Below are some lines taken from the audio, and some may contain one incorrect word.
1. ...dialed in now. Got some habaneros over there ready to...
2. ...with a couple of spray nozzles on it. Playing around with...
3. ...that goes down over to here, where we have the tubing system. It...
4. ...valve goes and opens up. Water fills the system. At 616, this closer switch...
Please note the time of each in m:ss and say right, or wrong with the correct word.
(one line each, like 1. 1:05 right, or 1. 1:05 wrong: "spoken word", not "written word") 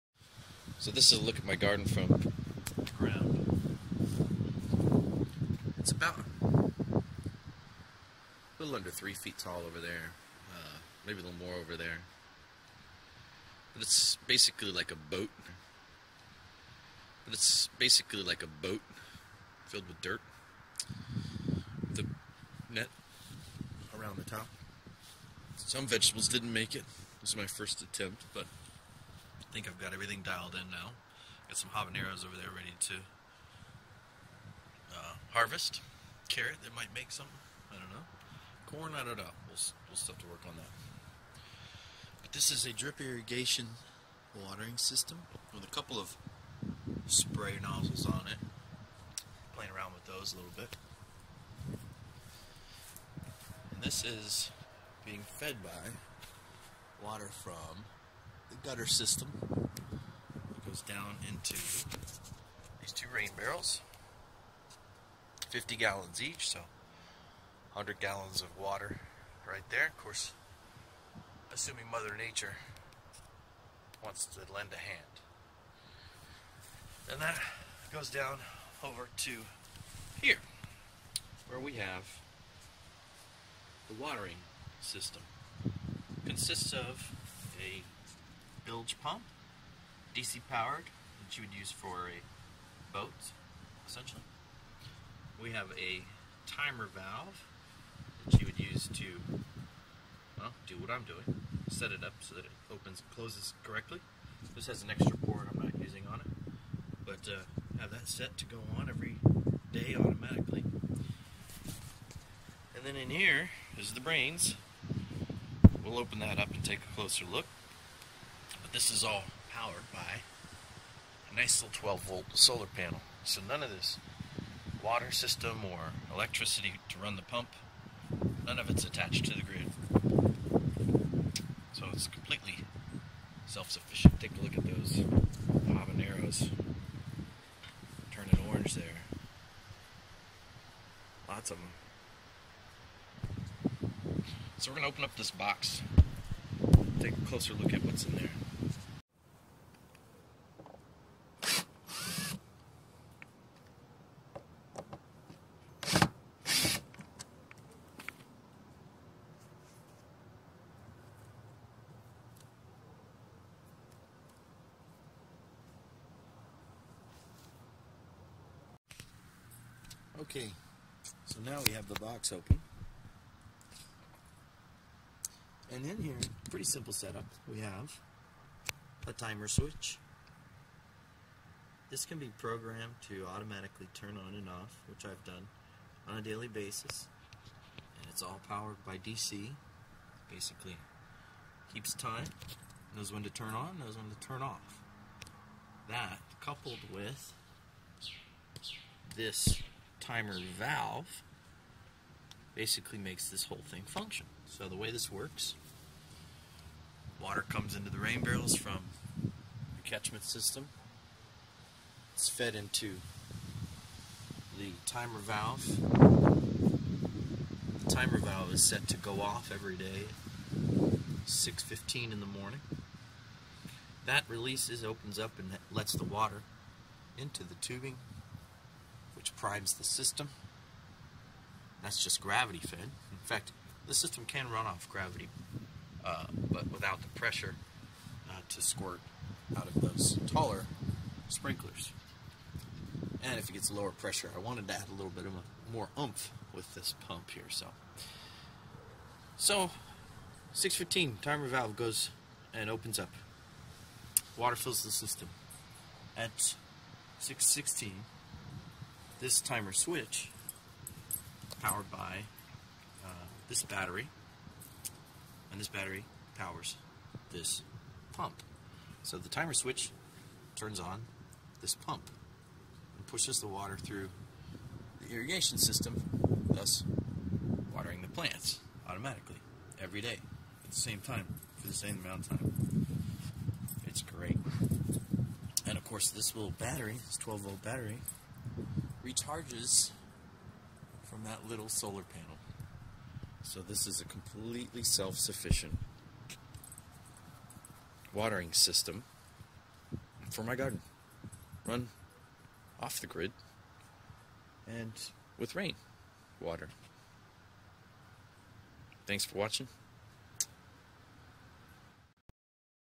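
1. 0:30 right
2. 0:45 right
3. 1:17 wrong: "watering", not "tubing"
4. 4:11 wrong: "timer", not "closer".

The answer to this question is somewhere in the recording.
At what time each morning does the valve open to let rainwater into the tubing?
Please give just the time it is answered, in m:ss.
3:41.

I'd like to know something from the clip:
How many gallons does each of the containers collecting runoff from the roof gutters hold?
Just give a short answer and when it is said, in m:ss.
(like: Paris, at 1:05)
50 gallons, at 1:05.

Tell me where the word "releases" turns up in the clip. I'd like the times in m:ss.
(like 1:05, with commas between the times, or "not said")
3:44.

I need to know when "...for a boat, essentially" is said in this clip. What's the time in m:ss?
1:31.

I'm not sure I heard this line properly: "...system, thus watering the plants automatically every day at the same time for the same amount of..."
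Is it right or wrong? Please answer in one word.
right.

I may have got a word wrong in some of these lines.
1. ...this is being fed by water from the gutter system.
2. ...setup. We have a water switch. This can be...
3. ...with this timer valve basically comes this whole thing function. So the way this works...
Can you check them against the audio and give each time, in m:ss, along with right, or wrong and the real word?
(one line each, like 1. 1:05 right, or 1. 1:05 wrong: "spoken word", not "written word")
1. 0:53 right
2. 2:56 wrong: "timer", not "water"
3. 3:16 wrong: "makes", not "comes".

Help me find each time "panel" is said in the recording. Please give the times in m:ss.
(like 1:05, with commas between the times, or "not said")
2:02, 4:52.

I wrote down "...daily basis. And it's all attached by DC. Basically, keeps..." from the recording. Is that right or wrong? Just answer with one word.
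wrong.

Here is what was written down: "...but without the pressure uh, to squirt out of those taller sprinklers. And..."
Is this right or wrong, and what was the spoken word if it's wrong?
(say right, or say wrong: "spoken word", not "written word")
right.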